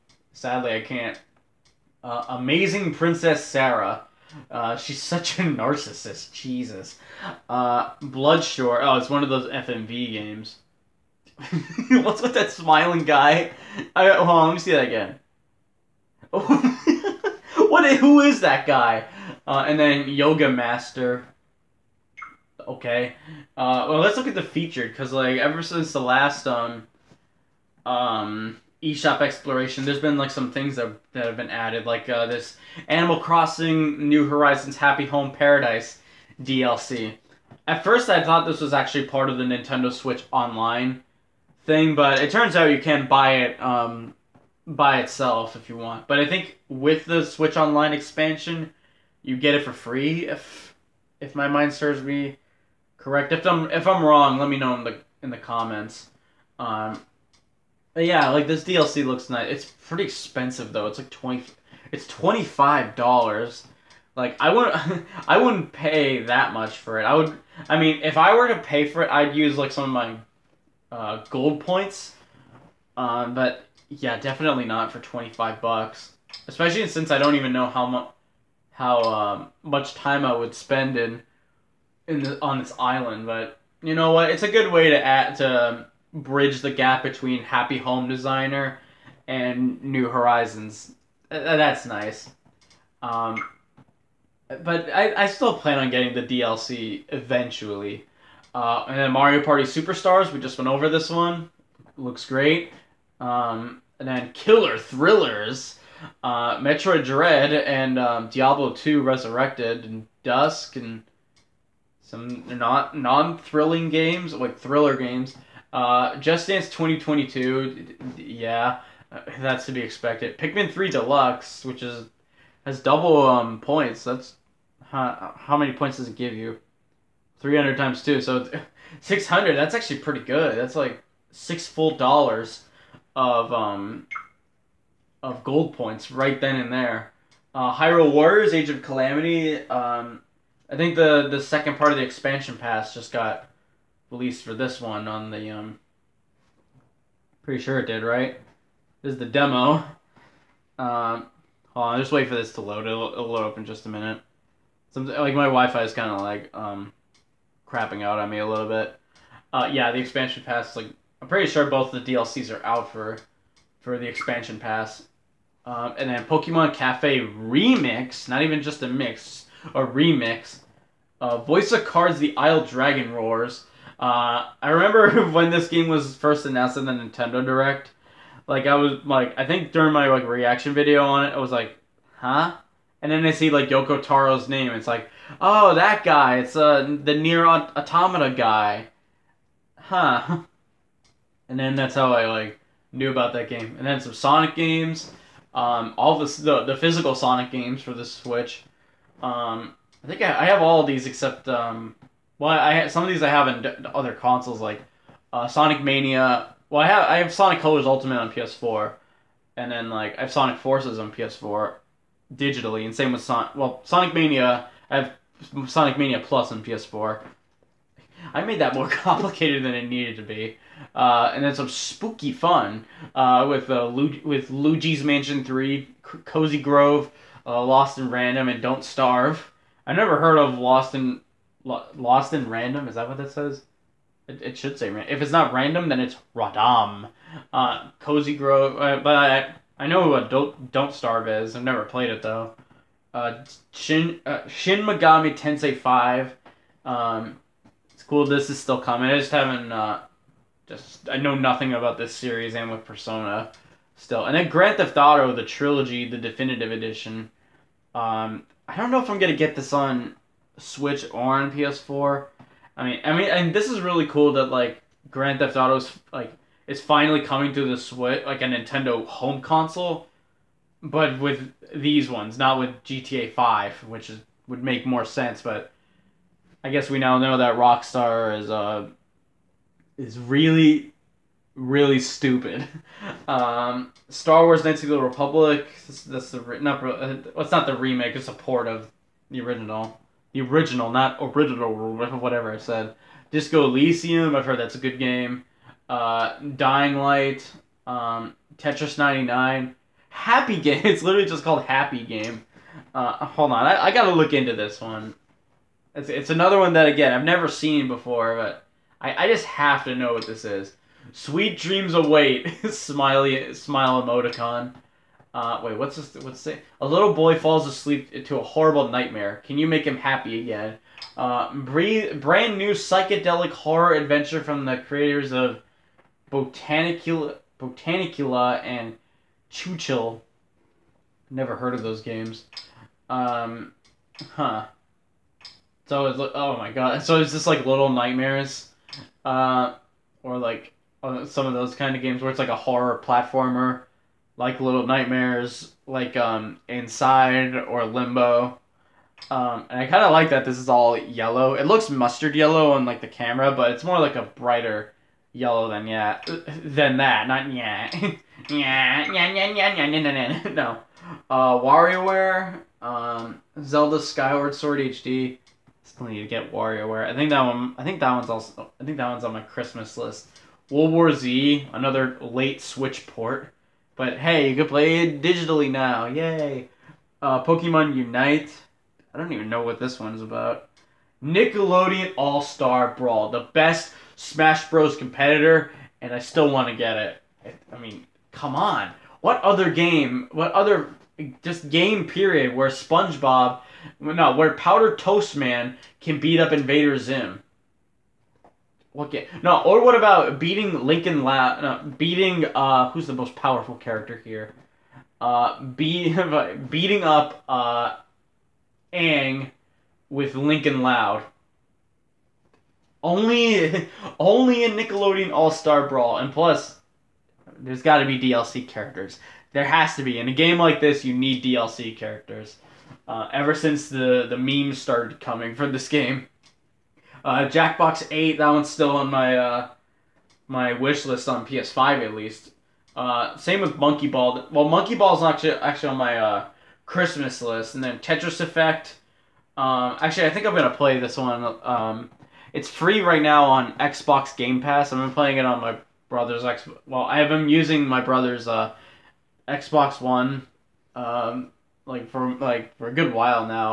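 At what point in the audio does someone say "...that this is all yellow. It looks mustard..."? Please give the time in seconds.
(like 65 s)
350 s.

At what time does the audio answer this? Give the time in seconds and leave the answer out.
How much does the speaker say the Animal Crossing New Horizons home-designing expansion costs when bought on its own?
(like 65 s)
62 s.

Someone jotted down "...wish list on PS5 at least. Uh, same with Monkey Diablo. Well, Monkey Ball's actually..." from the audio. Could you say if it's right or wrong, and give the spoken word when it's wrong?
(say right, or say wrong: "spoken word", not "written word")
wrong: "Ball", not "Diablo".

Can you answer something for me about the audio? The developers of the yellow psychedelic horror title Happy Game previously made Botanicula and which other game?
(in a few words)
Chuchel.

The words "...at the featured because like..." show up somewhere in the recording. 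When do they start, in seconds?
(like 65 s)
24 s.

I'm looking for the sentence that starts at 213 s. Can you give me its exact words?
Well, Sonic Mania I have Sonic Mania Plus on PS4.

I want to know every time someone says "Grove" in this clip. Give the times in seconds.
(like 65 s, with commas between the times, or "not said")
226 s, 238 s.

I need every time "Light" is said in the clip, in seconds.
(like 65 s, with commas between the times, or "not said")
296 s.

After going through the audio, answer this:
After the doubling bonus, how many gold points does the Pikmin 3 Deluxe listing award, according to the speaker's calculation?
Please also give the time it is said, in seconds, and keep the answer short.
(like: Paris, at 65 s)
600, at 129 s.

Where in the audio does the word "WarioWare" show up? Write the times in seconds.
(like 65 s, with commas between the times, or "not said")
361 s, 366 s.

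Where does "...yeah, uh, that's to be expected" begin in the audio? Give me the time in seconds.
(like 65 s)
118 s.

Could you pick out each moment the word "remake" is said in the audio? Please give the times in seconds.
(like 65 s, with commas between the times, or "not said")
287 s.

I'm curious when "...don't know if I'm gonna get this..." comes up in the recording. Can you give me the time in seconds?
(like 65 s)
258 s.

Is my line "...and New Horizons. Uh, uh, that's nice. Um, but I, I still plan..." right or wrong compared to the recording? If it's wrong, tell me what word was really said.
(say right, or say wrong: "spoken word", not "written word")
right.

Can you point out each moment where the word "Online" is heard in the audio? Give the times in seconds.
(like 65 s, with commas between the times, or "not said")
40 s, 47 s.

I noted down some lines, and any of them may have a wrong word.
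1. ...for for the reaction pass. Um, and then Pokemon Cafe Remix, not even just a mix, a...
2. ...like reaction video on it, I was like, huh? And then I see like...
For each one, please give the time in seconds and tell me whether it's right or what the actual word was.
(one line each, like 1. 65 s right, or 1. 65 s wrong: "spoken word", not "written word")
1. 162 s wrong: "expansion", not "reaction"
2. 180 s right.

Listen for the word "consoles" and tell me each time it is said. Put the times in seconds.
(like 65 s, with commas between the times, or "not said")
204 s, 269 s.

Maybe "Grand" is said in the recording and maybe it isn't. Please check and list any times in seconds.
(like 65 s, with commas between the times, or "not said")
254 s, 265 s.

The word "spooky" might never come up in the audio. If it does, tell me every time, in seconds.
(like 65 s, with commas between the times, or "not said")
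221 s.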